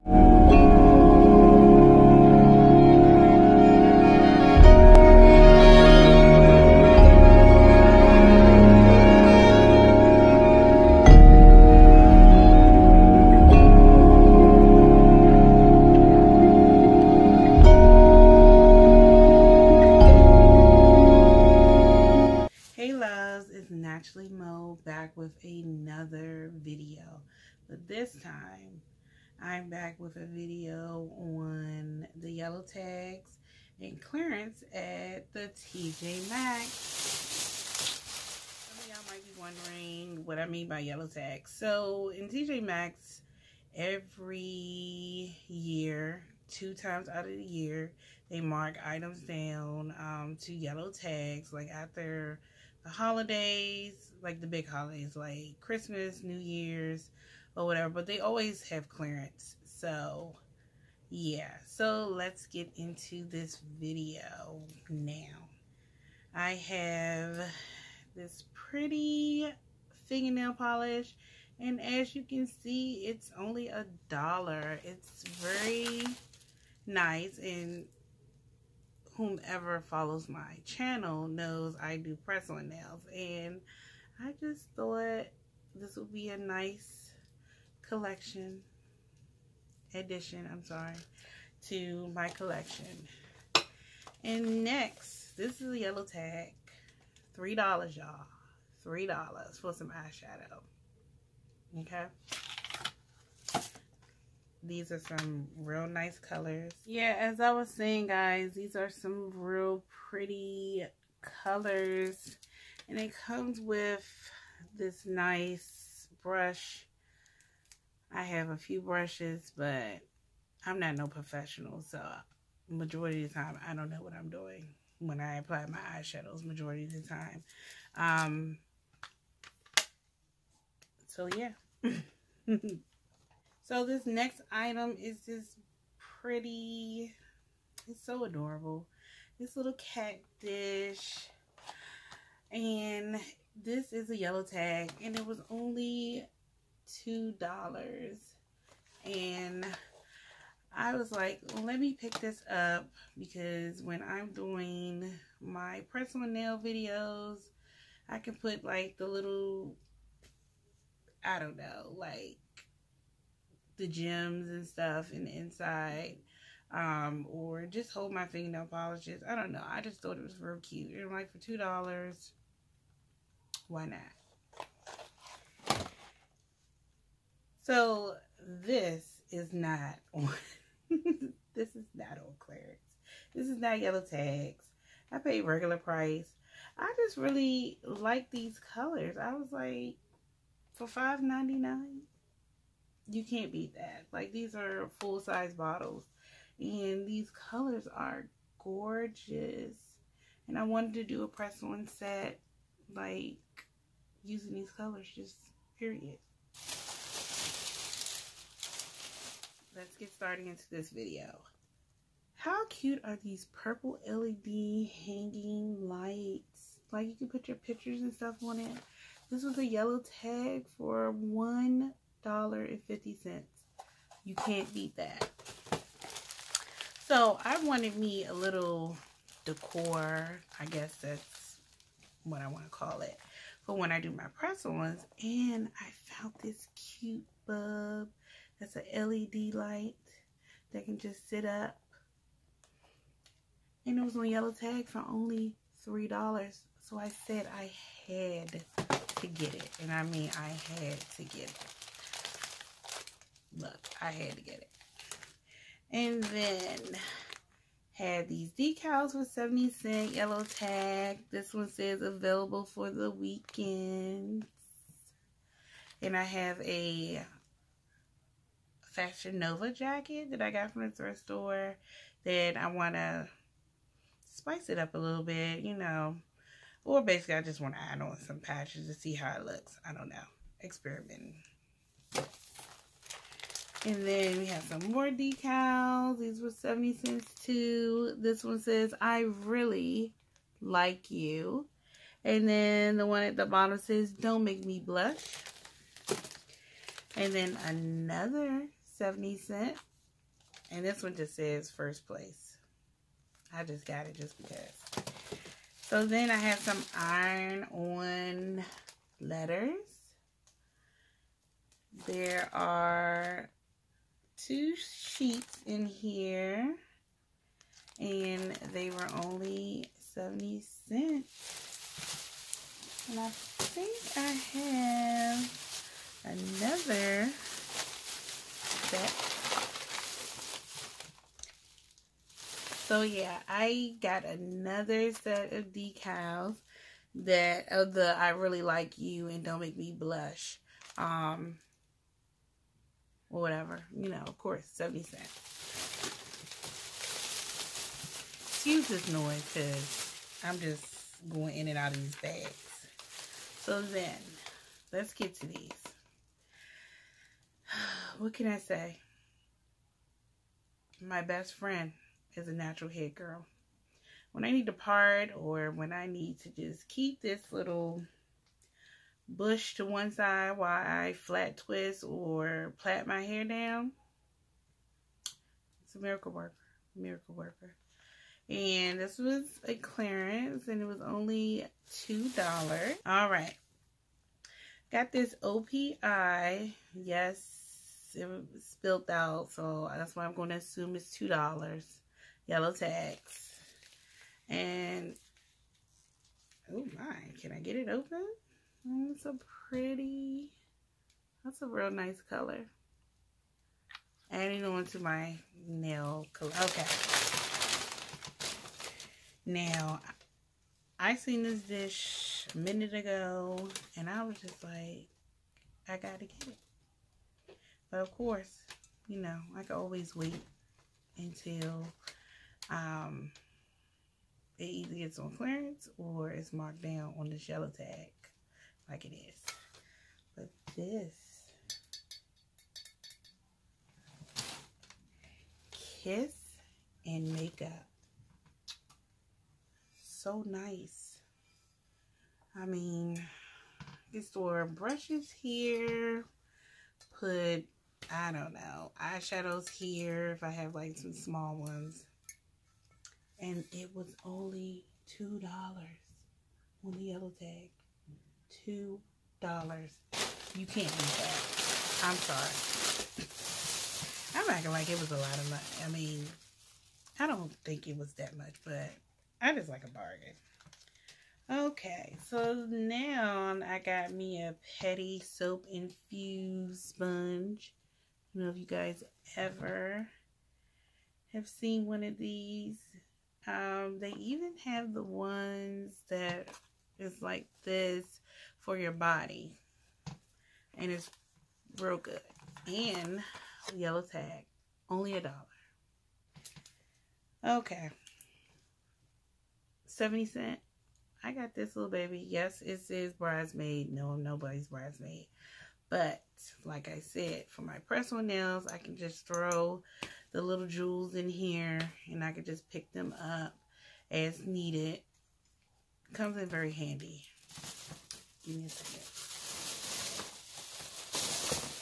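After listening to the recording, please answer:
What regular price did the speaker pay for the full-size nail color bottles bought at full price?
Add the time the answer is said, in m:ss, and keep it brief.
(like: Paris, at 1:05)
$5.99, at 3:10.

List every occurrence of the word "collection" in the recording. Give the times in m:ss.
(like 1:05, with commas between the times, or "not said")
1:27, 1:32.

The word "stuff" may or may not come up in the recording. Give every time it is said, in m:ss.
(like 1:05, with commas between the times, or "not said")
2:44, 3:38.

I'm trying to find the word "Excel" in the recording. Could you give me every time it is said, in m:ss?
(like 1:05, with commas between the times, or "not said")
not said.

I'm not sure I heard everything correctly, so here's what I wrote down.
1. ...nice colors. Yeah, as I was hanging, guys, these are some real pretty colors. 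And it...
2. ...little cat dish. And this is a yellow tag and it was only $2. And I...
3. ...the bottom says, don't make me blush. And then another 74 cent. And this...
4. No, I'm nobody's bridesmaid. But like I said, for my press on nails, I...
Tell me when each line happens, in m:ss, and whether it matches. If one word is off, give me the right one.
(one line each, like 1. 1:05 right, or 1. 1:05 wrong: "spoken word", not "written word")
1. 1:45 wrong: "saying", not "hanging"
2. 2:19 right
3. 4:53 wrong: "70", not "74"
4. 8:23 right.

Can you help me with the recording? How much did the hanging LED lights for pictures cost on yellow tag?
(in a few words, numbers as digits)
$1.50.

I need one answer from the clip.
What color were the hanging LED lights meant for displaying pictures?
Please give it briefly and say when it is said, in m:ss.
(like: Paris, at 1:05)
Purple, at 3:33.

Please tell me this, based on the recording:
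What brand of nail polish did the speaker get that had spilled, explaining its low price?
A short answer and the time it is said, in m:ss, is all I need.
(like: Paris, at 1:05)
OPI, at 6:25.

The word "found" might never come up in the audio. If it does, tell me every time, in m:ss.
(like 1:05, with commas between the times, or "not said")
3:56.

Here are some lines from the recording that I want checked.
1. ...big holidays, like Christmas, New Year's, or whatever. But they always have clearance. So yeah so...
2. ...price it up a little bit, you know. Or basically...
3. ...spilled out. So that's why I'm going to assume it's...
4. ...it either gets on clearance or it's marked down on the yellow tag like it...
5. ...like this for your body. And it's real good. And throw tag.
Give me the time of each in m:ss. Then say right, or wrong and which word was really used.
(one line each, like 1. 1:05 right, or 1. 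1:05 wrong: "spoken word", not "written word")
1. 0:54 right
2. 4:34 wrong: "spice", not "price"
3. 6:28 right
4. 7:04 right
5. 8:07 wrong: "yellow", not "throw".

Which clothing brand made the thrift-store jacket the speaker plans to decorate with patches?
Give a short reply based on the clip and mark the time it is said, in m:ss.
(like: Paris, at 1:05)
Fashion Nova, at 4:28.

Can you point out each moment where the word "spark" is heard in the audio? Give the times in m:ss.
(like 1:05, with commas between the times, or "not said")
not said.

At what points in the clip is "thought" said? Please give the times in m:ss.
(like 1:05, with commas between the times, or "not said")
1:24, 2:50.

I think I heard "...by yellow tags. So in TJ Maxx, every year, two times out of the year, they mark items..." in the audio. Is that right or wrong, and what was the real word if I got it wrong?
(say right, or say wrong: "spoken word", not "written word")
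right.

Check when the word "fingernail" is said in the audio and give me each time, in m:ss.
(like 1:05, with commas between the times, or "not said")
1:10, 2:48.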